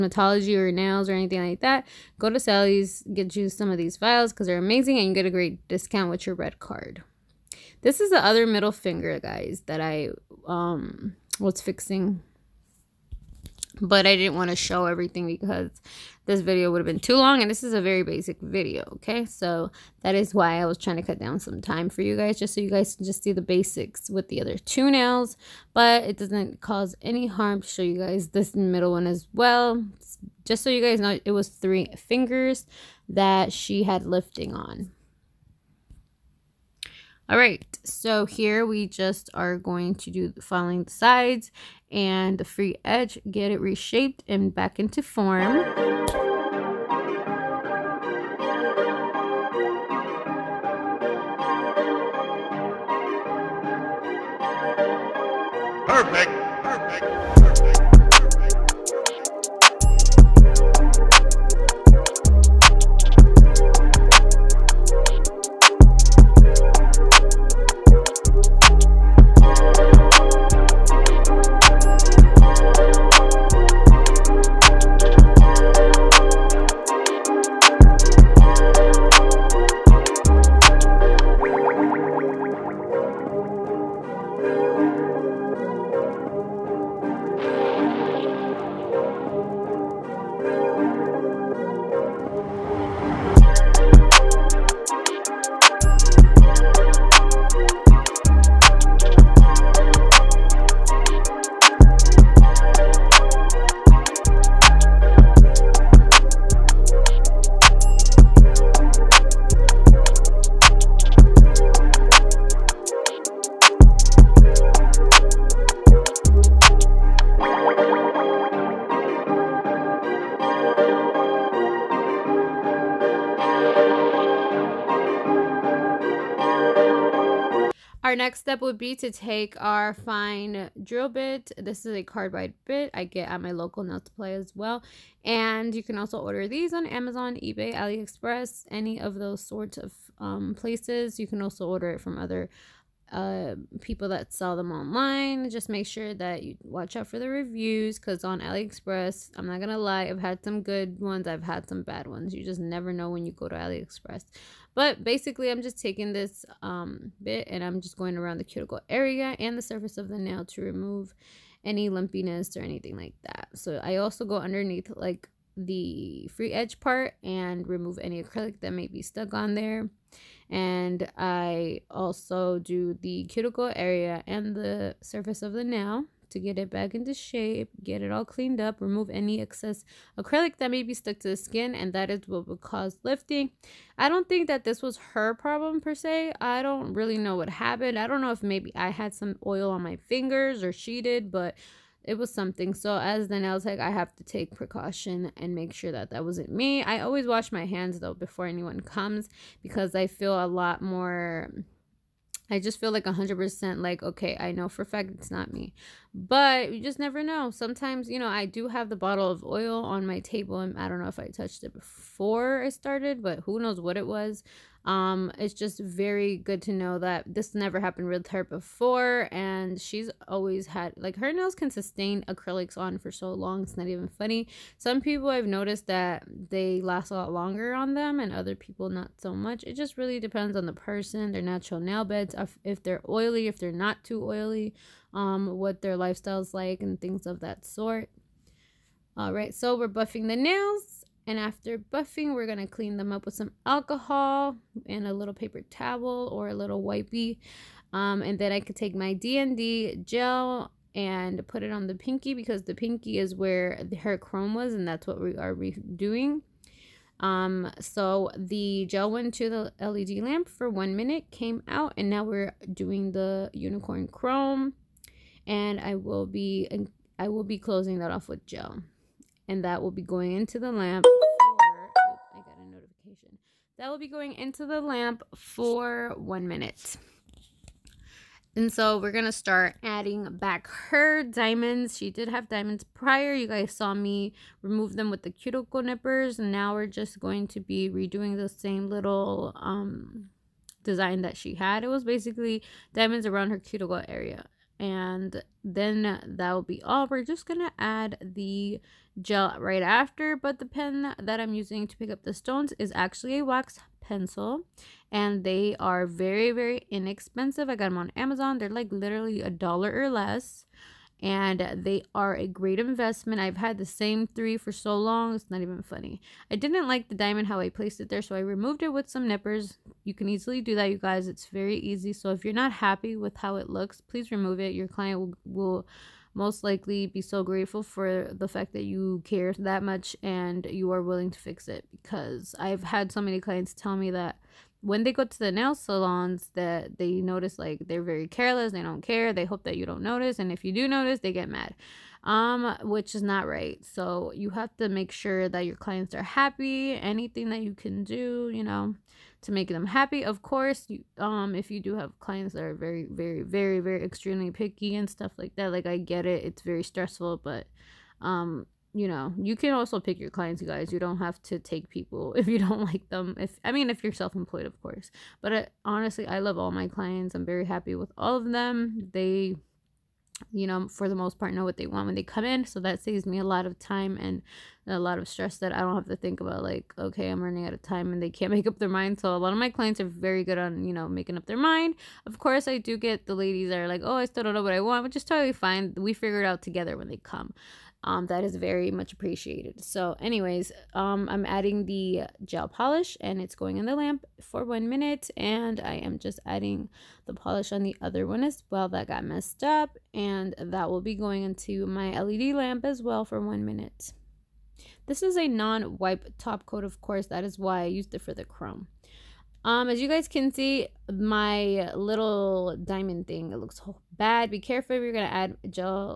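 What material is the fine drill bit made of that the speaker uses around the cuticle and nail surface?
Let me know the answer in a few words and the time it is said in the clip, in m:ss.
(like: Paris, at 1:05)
Carbide, at 2:12.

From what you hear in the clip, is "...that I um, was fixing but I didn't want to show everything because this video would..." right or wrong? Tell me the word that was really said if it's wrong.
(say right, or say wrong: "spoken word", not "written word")
right.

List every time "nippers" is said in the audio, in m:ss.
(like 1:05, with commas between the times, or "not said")
4:45, 5:19.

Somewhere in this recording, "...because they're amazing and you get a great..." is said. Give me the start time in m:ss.
0:04.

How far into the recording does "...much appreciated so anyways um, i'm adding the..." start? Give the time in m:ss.
6:28.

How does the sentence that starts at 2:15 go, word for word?
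And you can also order these on Amazon, eBay, AliExpress, any of those sorts of um, places.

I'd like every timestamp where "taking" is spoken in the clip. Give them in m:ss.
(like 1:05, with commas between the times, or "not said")
2:35.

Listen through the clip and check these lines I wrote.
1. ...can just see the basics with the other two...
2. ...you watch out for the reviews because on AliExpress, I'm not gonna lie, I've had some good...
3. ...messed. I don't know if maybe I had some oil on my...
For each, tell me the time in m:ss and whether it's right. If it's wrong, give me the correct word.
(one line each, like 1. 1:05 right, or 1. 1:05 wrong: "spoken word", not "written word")
1. 0:22 right
2. 2:26 right
3. 3:07 wrong: "happened", not "messed".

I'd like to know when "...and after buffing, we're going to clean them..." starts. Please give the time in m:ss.
4:01.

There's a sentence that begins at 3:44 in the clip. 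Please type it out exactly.
Some people I've noticed that they last a lot longer on them, and other people not so much.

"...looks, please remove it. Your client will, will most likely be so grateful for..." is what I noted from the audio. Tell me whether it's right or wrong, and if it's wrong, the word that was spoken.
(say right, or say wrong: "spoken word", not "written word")
right.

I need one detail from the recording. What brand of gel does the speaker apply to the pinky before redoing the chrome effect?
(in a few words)
DND.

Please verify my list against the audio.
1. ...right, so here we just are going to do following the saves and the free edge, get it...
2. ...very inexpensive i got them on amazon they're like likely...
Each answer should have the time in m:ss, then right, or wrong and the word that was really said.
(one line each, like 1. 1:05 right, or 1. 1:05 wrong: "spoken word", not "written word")
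1. 0:37 wrong: "sides", not "saves"
2. 5:06 wrong: "literally", not "likely".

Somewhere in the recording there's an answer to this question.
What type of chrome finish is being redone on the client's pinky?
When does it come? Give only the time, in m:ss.
4:23.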